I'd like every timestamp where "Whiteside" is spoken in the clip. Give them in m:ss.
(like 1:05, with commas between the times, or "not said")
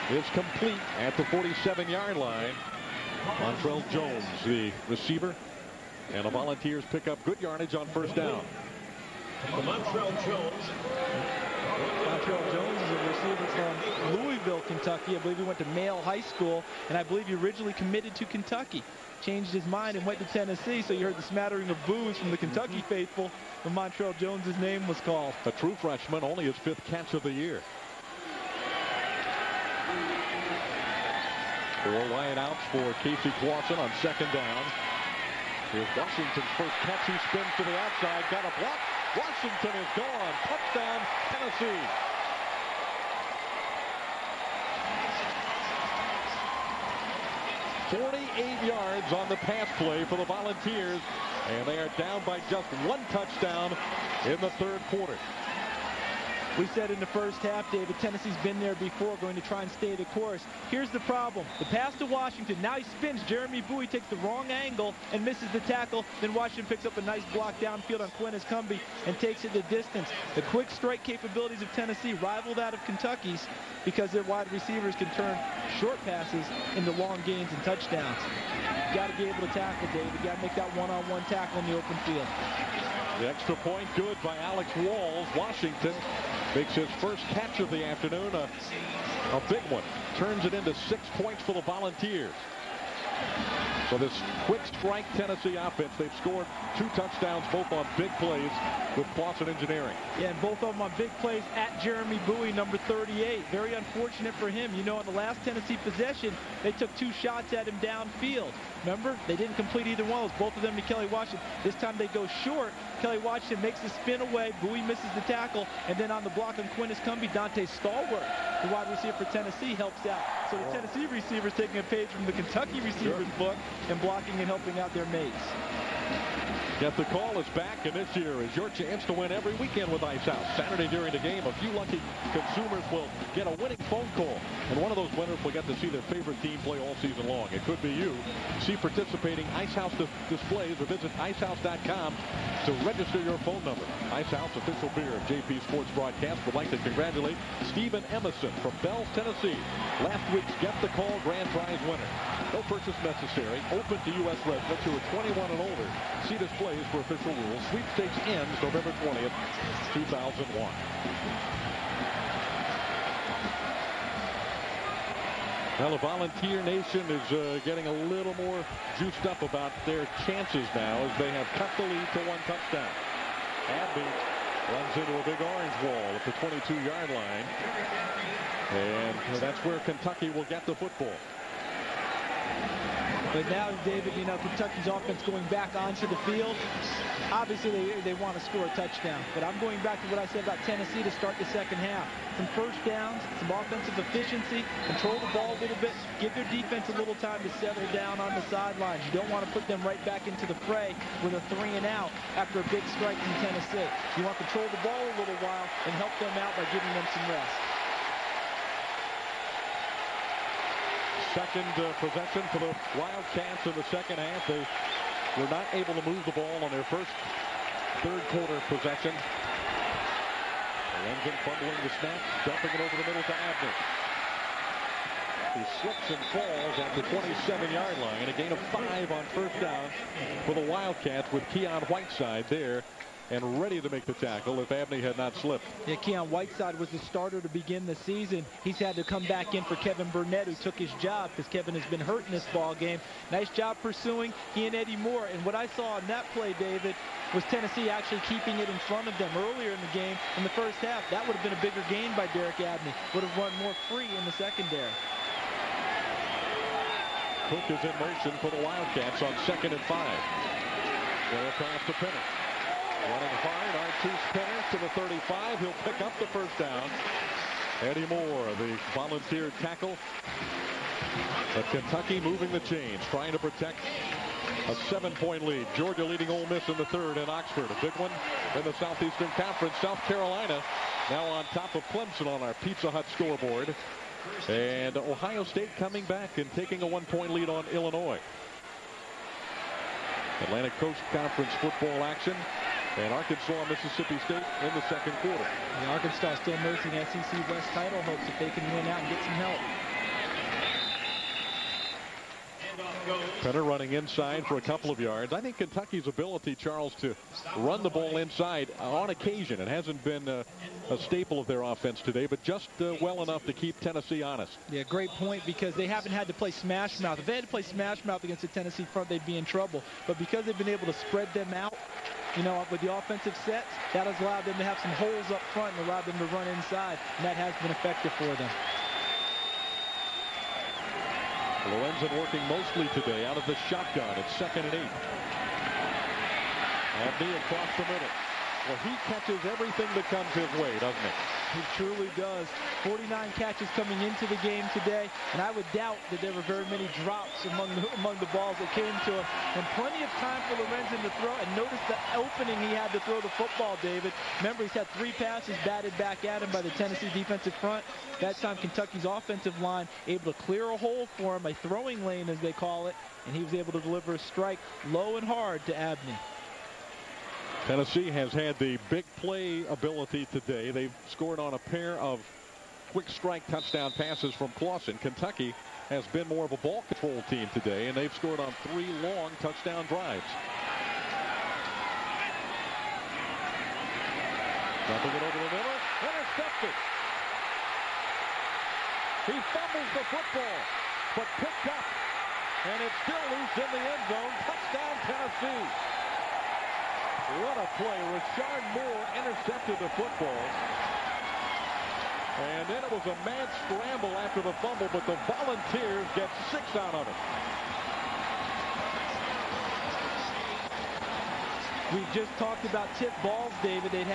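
3:51, 3:56.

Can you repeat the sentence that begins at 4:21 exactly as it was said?
Way across the Running hard, Artose Pinner to the 35.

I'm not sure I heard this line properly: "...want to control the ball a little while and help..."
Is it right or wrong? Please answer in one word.
right.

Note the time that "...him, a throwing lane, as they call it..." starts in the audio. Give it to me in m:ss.
6:01.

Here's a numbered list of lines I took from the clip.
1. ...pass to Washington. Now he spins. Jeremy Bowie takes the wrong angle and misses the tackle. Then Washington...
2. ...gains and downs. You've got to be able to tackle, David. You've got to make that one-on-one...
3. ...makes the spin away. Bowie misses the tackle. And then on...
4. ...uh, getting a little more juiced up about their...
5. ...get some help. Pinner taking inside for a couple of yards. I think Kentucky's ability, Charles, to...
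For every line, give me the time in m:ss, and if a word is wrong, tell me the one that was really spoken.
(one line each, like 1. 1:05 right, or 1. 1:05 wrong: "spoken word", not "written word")
1. 1:01 right
2. 1:17 wrong: "touchdowns", not "downs"
3. 1:53 right
4. 2:47 right
5. 4:59 wrong: "running", not "taking".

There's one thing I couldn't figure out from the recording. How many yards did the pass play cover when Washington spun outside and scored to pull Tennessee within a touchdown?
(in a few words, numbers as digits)
48.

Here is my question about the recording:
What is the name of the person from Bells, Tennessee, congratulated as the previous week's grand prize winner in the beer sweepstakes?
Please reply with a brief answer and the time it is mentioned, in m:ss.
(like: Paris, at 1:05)
Stephen Emerson, at 2:27.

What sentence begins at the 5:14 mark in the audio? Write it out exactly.
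Yeah, great point because they haven't had to play smash mouth.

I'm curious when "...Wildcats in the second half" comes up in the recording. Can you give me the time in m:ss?
3:32.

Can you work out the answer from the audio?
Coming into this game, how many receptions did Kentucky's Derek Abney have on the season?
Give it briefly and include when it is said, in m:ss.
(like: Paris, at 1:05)
49, at 5:42.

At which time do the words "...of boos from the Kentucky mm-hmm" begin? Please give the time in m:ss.
0:21.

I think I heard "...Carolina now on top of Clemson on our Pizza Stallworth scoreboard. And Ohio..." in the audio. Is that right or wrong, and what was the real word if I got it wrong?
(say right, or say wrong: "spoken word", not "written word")
wrong: "Hut", not "Stallworth".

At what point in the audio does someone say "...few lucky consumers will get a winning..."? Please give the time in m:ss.
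2:11.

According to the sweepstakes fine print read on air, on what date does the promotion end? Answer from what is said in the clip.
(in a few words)
November 20th, 2001.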